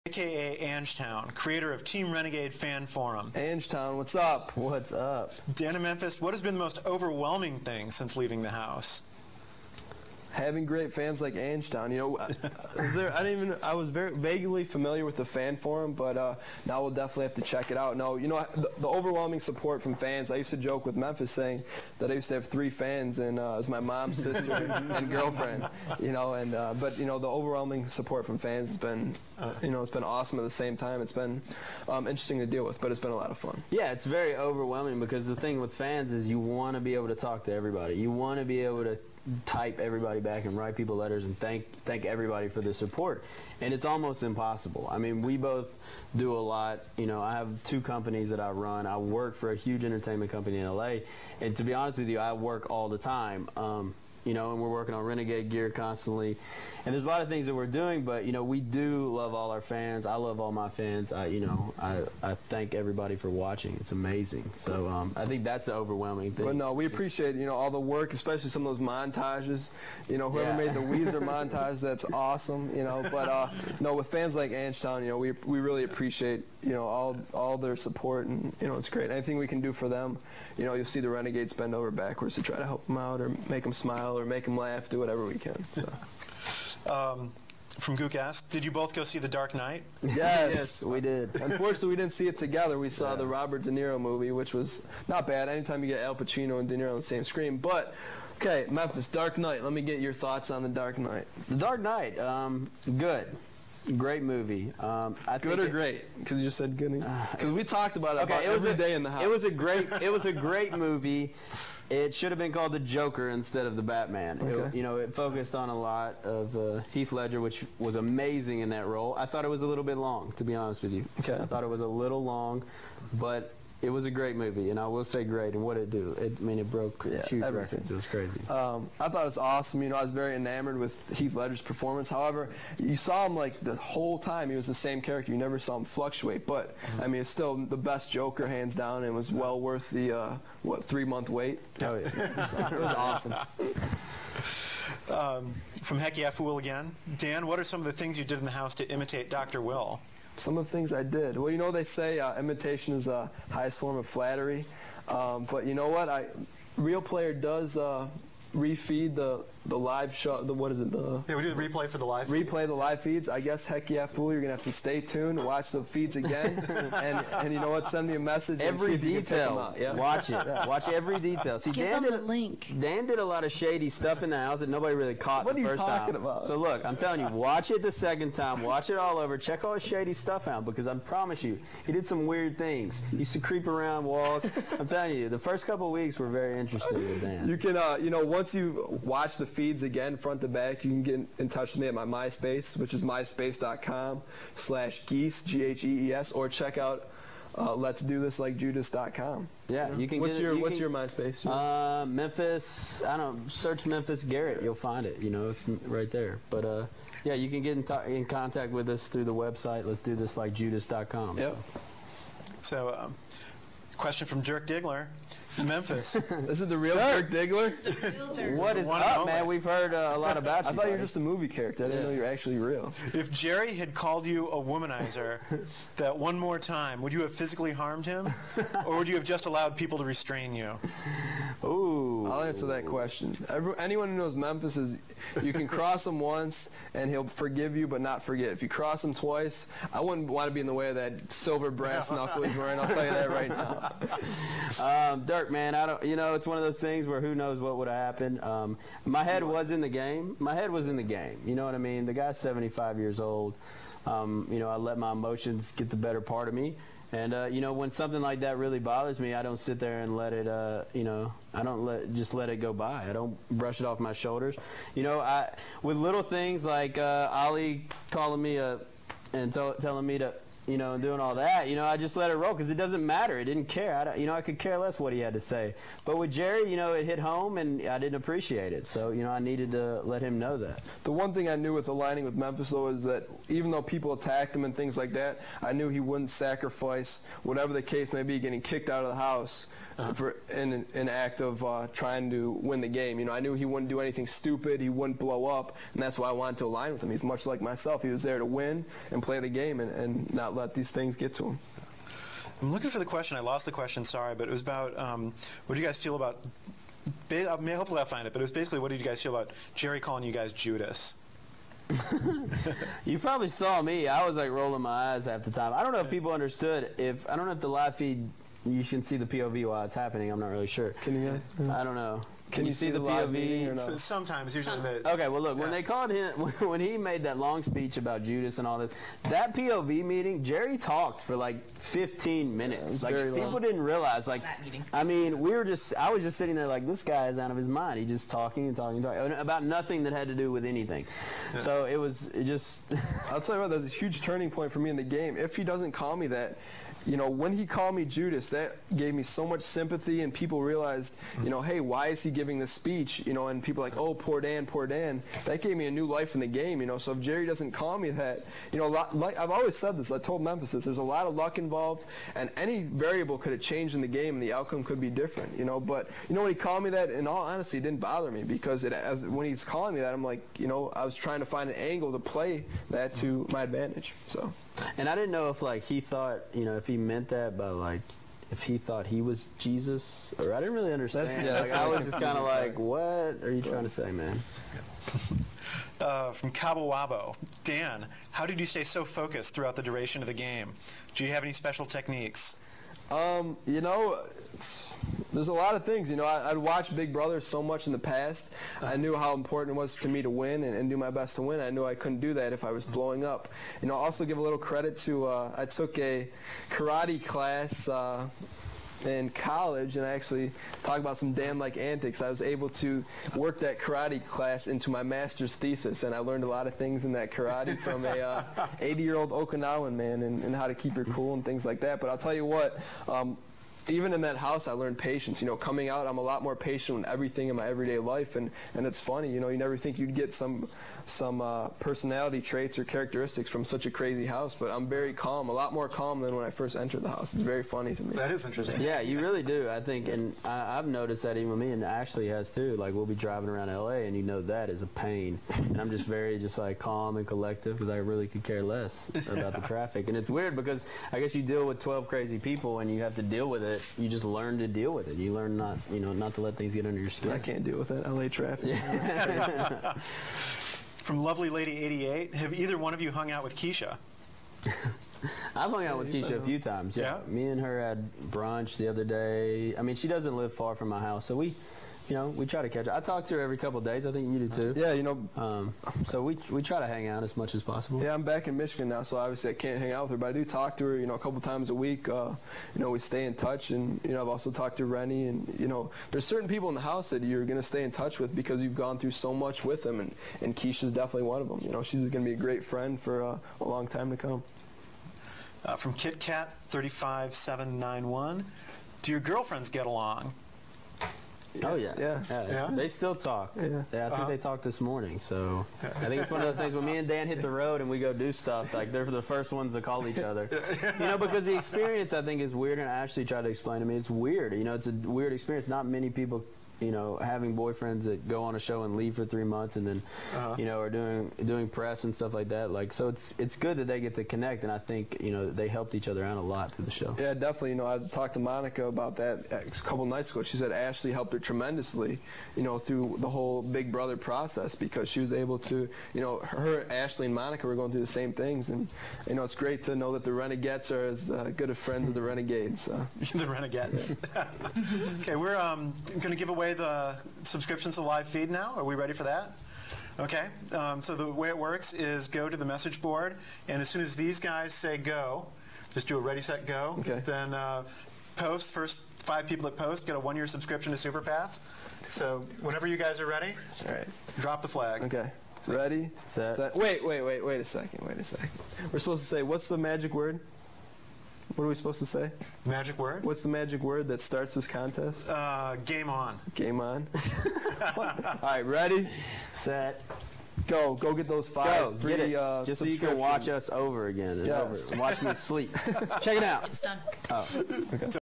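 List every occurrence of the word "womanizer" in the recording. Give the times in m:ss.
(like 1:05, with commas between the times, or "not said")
3:44.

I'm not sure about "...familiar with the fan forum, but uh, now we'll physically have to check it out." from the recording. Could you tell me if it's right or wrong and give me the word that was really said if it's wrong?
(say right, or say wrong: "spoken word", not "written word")
wrong: "definitely", not "physically".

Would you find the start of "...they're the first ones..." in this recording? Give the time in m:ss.
8:28.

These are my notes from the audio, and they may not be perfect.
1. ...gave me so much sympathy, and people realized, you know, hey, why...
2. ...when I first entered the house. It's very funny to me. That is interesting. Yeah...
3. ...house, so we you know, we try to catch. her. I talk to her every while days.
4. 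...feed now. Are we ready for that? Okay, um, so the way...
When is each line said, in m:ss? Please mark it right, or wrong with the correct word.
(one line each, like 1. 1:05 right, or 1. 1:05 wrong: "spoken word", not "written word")
1. 5:48 right
2. 7:16 right
3. 7:50 wrong: "couple", not "while"
4. 9:08 right.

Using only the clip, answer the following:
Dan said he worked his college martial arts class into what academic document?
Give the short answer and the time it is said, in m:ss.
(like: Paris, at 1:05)
Master's thesis, at 6:55.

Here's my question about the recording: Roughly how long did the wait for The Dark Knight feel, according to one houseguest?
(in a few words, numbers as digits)
3 months.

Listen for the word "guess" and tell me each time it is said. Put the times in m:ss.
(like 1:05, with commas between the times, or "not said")
2:43, 7:31.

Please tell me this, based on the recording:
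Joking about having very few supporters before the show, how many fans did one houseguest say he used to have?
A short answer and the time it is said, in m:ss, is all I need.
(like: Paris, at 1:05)
3, at 0:22.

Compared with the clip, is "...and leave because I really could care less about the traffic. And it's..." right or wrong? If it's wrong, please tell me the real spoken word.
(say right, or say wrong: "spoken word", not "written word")
wrong: "collective", not "leave".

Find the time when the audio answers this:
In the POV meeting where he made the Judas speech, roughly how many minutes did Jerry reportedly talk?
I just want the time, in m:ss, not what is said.
5:31.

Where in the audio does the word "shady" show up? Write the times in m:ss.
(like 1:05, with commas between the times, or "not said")
2:53, 2:59.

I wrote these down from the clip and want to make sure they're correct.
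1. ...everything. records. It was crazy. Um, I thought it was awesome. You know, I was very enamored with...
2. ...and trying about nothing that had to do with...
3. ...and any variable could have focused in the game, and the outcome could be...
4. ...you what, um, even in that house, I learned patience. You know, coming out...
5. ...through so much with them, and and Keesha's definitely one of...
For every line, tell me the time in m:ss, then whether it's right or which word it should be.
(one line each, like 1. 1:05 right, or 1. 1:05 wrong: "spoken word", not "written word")
1. 2:07 right
2. 5:38 wrong: "talking", not "trying"
3. 6:02 wrong: "changed", not "focused"
4. 7:02 right
5. 8:08 right.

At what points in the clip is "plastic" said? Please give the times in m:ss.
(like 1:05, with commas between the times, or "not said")
not said.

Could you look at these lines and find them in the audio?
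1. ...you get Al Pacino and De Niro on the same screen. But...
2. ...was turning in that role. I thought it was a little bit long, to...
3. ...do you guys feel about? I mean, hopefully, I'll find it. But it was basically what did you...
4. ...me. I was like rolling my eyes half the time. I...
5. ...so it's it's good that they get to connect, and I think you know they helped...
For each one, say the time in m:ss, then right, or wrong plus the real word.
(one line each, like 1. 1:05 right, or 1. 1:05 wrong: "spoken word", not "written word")
1. 1:35 right
2. 1:57 wrong: "amazing", not "turning"
3. 5:05 right
4. 5:13 right
5. 8:42 right.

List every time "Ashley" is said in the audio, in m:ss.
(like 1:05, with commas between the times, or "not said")
7:21, 8:32, 8:50, 8:56.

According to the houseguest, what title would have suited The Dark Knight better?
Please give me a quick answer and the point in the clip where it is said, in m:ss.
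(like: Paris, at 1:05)
The Joker, at 1:52.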